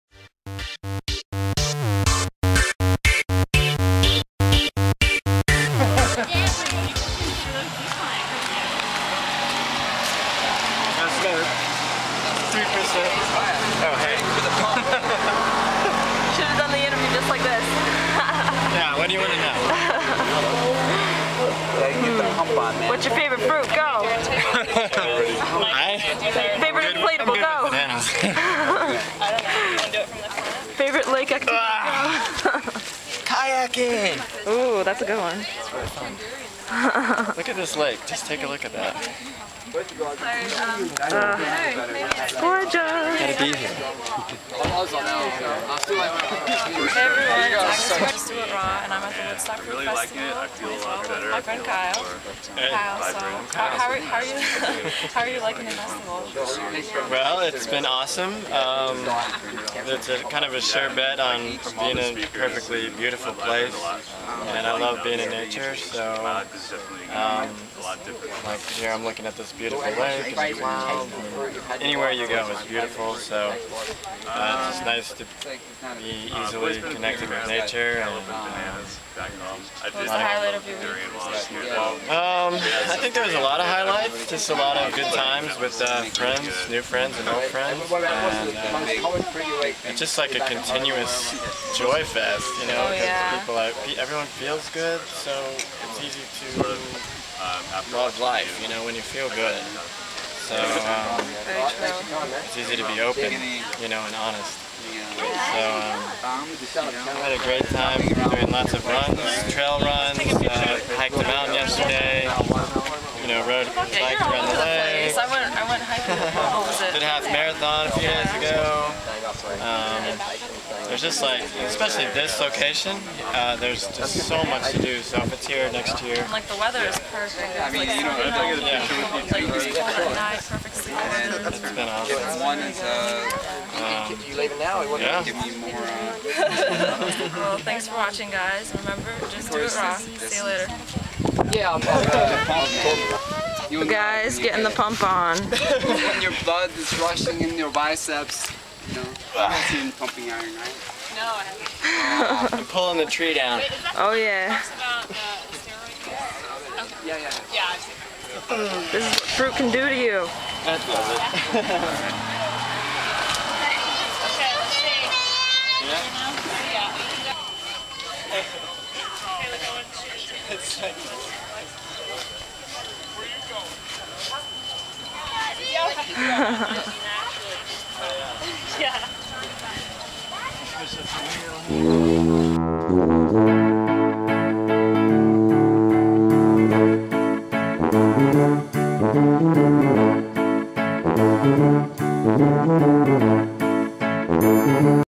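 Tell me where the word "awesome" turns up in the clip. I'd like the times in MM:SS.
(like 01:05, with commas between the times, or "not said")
00:57, 02:11.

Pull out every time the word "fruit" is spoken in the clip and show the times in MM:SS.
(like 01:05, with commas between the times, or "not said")
00:23, 02:39.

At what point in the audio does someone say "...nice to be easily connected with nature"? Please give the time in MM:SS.
01:14.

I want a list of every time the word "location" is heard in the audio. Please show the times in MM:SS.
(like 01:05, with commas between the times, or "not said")
02:02.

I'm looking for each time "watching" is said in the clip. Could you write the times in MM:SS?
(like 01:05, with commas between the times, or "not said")
02:17.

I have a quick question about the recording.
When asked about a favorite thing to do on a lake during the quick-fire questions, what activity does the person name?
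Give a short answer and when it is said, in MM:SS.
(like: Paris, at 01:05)
Kayaking, at 00:33.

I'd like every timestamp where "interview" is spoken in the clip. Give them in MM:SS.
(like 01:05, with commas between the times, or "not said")
00:16.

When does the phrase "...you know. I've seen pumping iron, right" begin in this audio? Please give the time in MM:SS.
02:28.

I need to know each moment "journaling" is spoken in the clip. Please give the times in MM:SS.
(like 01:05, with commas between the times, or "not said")
not said.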